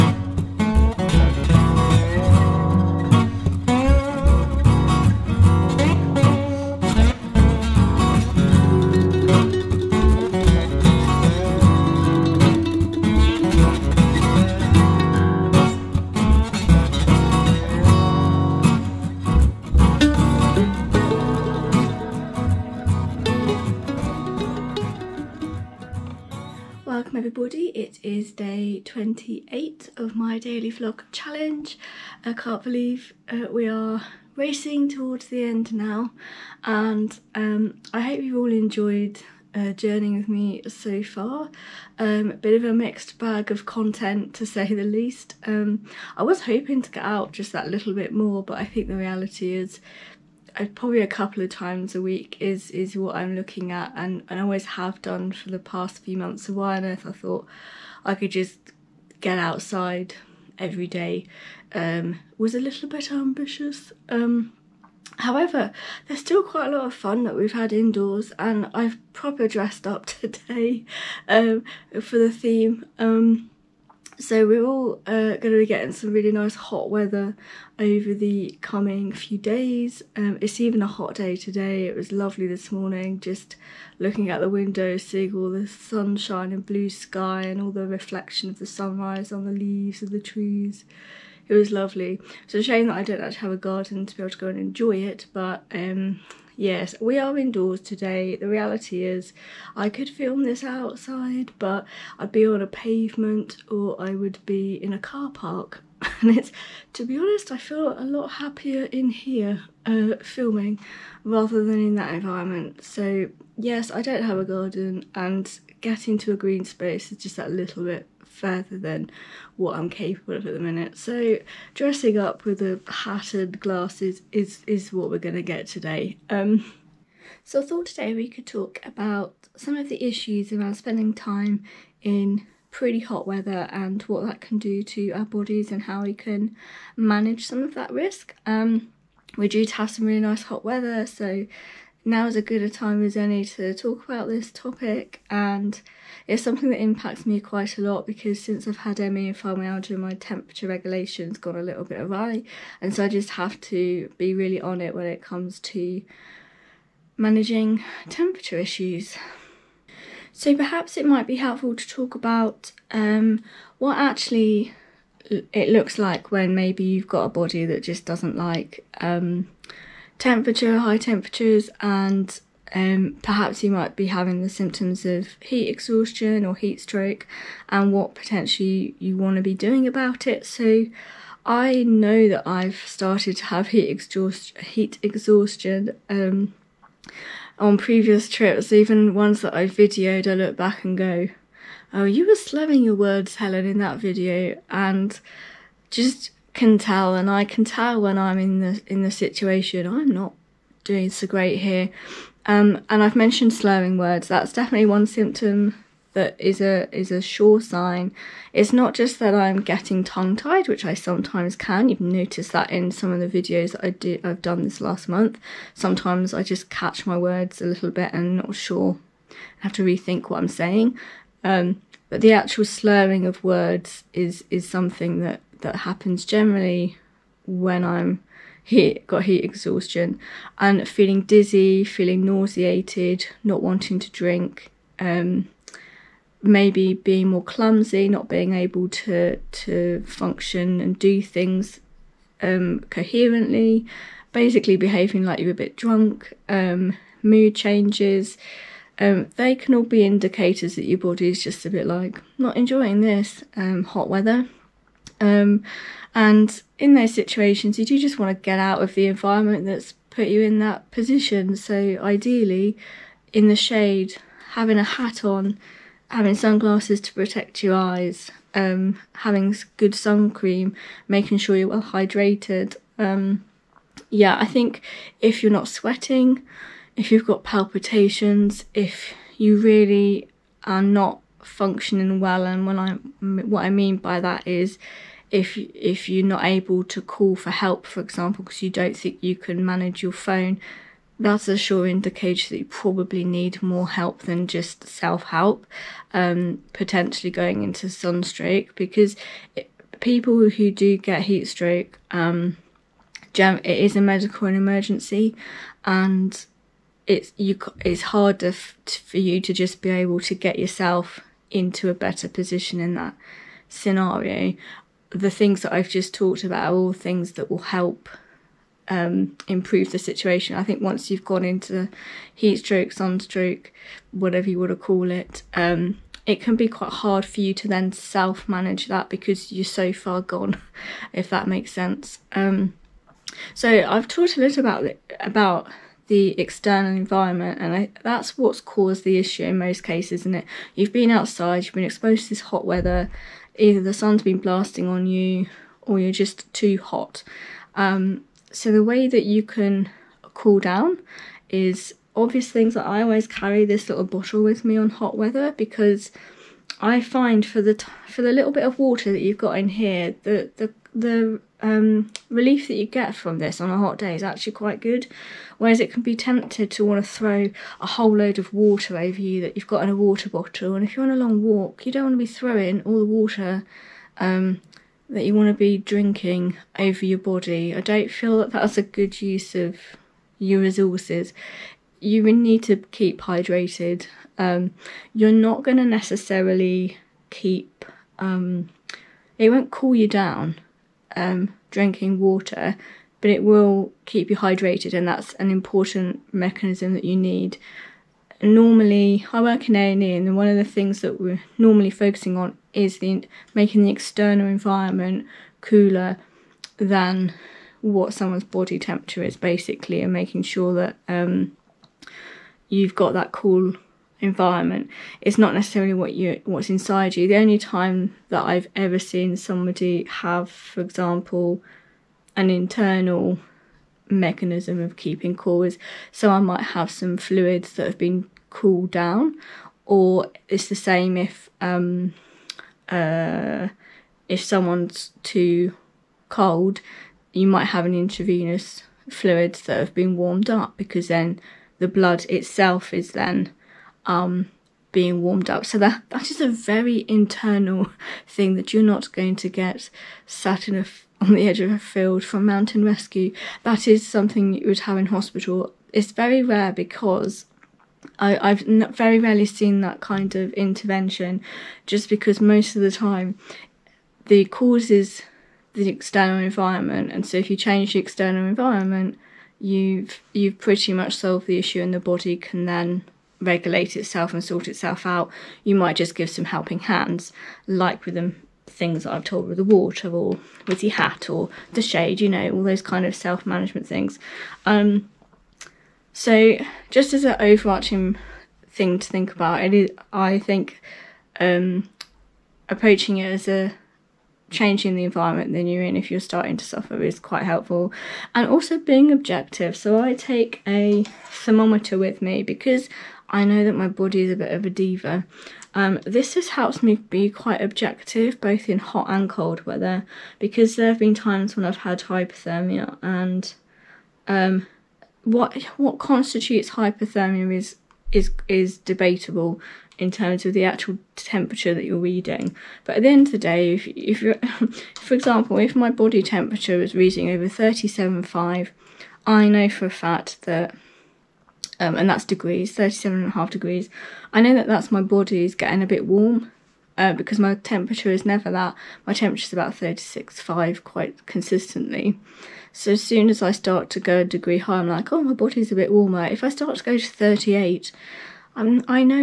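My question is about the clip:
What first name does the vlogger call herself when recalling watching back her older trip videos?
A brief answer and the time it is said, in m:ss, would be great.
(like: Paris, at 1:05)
Helen, at 3:13.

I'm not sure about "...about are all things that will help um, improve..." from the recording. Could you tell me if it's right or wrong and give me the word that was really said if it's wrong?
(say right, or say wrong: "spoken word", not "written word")
right.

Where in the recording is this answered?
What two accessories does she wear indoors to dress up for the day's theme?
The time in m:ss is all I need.
2:02.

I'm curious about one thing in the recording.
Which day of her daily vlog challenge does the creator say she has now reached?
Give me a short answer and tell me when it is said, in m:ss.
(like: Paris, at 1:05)
28, at 0:28.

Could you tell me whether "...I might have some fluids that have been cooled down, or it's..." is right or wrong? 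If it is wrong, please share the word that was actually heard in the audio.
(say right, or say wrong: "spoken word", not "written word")
right.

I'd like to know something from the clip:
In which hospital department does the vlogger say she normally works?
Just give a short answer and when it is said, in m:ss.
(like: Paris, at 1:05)
A and E, at 6:39.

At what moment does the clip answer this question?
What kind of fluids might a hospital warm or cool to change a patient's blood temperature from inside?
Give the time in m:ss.
7:17.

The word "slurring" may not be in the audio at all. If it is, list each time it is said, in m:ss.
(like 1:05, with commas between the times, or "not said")
3:12, 3:23, 3:42.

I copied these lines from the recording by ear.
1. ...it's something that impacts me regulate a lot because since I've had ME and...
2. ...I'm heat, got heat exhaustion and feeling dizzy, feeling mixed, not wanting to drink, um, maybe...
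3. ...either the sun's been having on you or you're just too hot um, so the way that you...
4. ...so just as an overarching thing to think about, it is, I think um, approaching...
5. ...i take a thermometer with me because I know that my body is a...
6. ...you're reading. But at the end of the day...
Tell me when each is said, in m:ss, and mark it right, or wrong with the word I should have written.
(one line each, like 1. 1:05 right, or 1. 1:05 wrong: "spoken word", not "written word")
1. 2:26 wrong: "quite", not "regulate"
2. 3:47 wrong: "nauseated", not "mixed"
3. 5:43 wrong: "blasting", not "having"
4. 8:06 right
5. 8:20 right
6. 8:41 right.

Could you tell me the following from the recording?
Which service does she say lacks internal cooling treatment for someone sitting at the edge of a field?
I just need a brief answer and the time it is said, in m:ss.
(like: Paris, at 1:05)
Mountain rescue, at 7:32.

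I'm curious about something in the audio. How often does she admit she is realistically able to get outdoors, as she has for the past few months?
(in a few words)
A couple of times a week.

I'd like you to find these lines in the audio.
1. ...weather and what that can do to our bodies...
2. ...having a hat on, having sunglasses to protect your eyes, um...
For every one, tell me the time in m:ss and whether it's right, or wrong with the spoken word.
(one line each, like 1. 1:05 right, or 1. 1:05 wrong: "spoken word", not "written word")
1. 2:13 right
2. 4:24 right.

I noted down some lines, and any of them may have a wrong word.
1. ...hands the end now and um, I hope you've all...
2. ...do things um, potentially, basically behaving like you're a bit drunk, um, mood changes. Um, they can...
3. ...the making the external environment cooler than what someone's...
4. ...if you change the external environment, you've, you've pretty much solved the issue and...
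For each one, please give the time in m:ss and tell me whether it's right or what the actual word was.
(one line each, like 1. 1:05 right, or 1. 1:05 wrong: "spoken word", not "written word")
1. 0:34 wrong: "towards", not "hands"
2. 4:00 wrong: "coherently", not "potentially"
3. 6:42 right
4. 7:47 right.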